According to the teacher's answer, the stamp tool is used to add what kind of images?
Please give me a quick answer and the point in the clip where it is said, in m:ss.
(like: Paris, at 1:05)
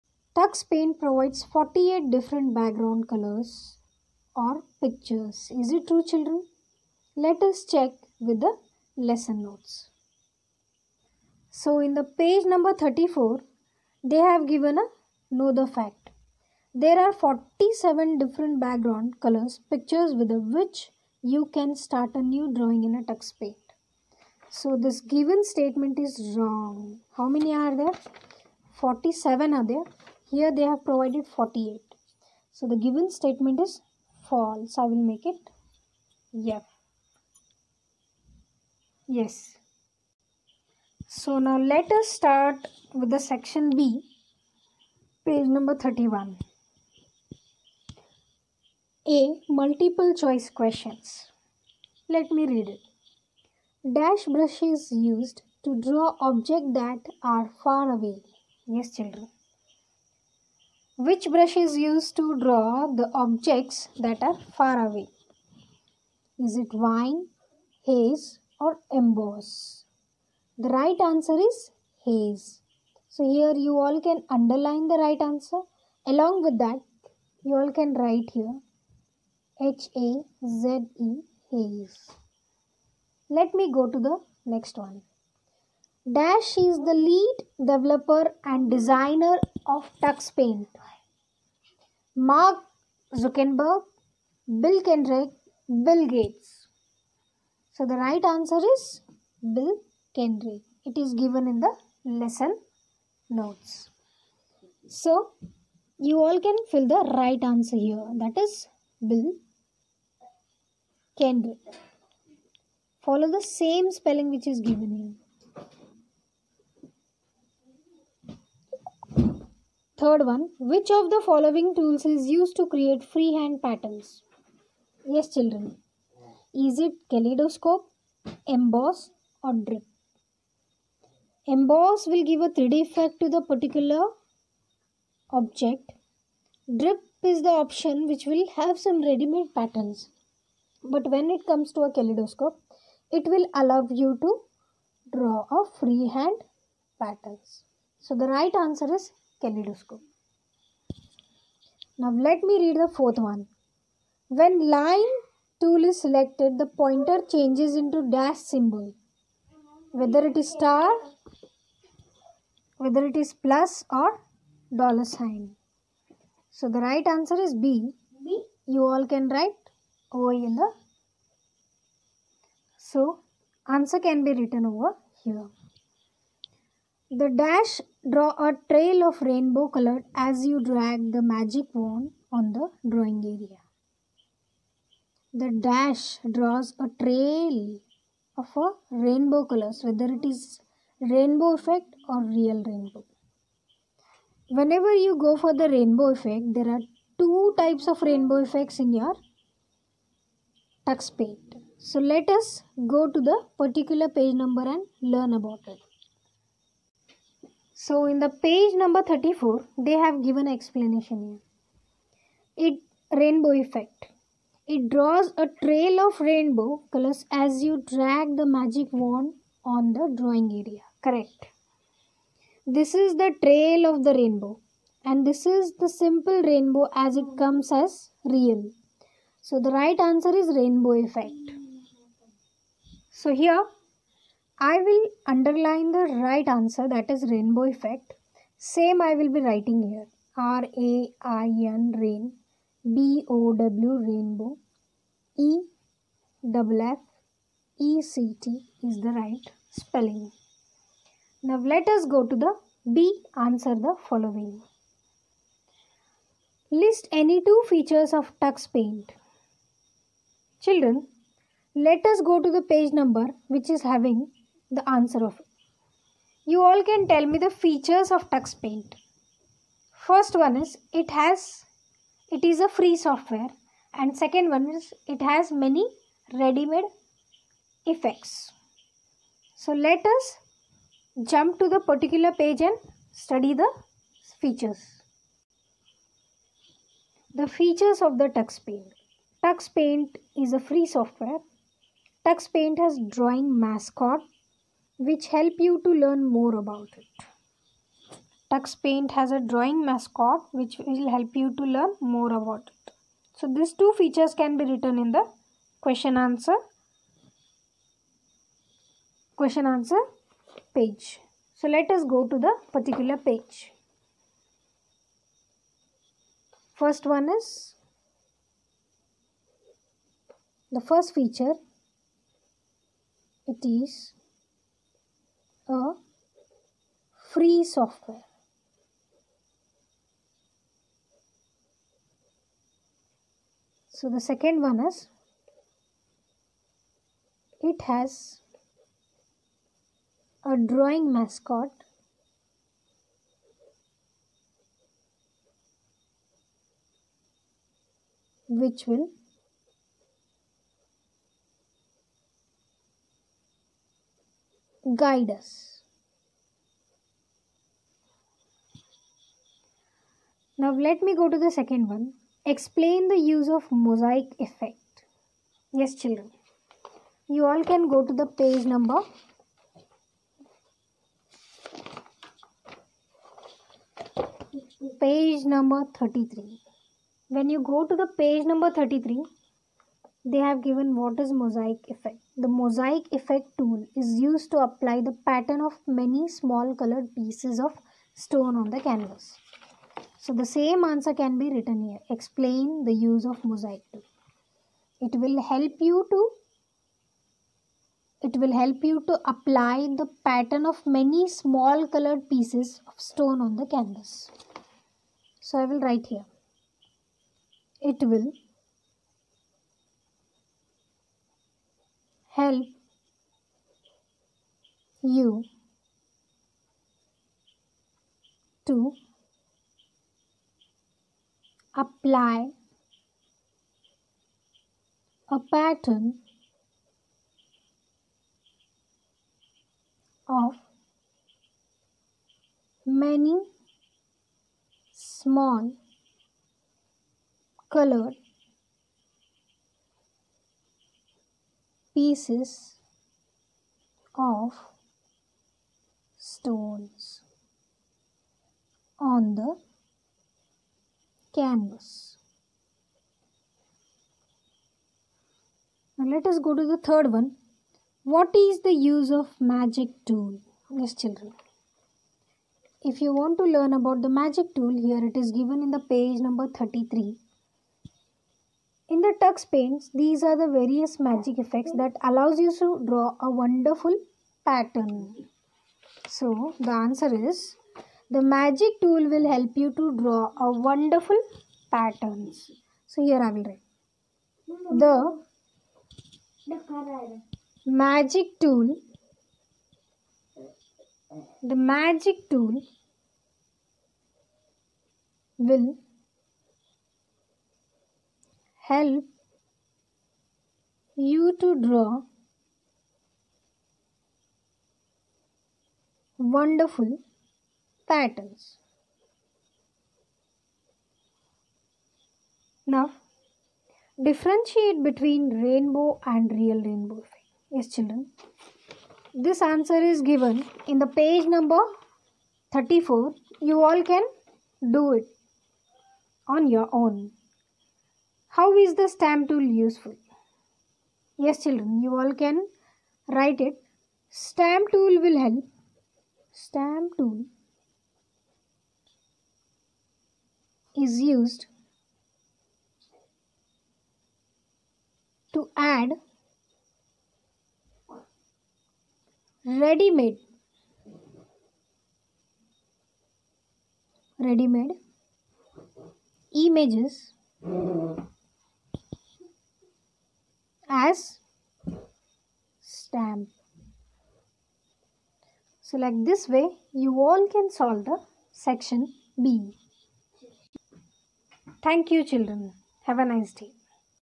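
ready-made images, at 9:09.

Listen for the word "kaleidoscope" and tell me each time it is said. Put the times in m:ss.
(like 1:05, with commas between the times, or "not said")
2:07, 2:21, 2:29.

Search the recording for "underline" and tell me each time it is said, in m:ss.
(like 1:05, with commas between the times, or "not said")
1:14, 3:55.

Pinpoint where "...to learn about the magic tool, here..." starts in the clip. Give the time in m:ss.
7:43.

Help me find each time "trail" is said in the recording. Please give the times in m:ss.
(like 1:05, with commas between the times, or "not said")
2:58, 3:07, 3:35, 3:43.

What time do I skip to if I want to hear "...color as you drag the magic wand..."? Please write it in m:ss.
2:59.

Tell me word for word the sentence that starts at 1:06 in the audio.
Is it wine, haze or emboss?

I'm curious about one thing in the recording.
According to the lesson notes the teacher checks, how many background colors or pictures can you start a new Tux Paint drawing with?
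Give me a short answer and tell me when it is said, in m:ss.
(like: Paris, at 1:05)
47, at 0:16.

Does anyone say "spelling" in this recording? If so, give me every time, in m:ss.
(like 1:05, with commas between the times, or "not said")
1:53, 4:09.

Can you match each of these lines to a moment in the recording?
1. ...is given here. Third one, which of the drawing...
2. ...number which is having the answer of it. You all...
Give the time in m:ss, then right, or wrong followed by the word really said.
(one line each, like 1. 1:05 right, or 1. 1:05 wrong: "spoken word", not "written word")
1. 1:54 wrong: "following", not "drawing"
2. 4:22 right.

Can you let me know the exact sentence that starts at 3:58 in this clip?
Same I will be writing here.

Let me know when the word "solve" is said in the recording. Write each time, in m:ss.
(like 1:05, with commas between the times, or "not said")
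9:27.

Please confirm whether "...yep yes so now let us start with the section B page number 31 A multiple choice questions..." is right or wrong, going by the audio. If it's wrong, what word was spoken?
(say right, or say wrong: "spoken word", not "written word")
right.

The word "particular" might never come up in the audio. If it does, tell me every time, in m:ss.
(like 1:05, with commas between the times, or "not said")
2:13, 3:23, 4:41, 5:12.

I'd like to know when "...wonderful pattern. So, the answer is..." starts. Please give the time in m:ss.
7:53.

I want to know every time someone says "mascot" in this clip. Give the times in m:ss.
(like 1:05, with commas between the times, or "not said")
4:53, 4:59, 5:41.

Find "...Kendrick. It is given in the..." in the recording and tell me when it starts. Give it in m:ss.
1:40.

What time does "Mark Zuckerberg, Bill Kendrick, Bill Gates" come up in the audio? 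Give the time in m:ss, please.
1:32.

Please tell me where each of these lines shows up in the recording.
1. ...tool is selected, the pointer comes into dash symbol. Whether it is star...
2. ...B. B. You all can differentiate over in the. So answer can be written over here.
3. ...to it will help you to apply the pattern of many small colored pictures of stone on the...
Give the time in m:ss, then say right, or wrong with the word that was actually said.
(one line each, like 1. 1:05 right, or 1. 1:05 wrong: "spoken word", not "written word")
1. 2:35 wrong: "changes", not "comes"
2. 2:47 wrong: "write", not "differentiate"
3. 6:36 wrong: "pieces", not "pictures".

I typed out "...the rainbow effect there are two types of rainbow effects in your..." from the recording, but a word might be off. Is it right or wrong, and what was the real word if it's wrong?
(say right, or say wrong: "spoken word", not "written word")
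right.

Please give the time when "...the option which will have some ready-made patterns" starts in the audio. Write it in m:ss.
2:17.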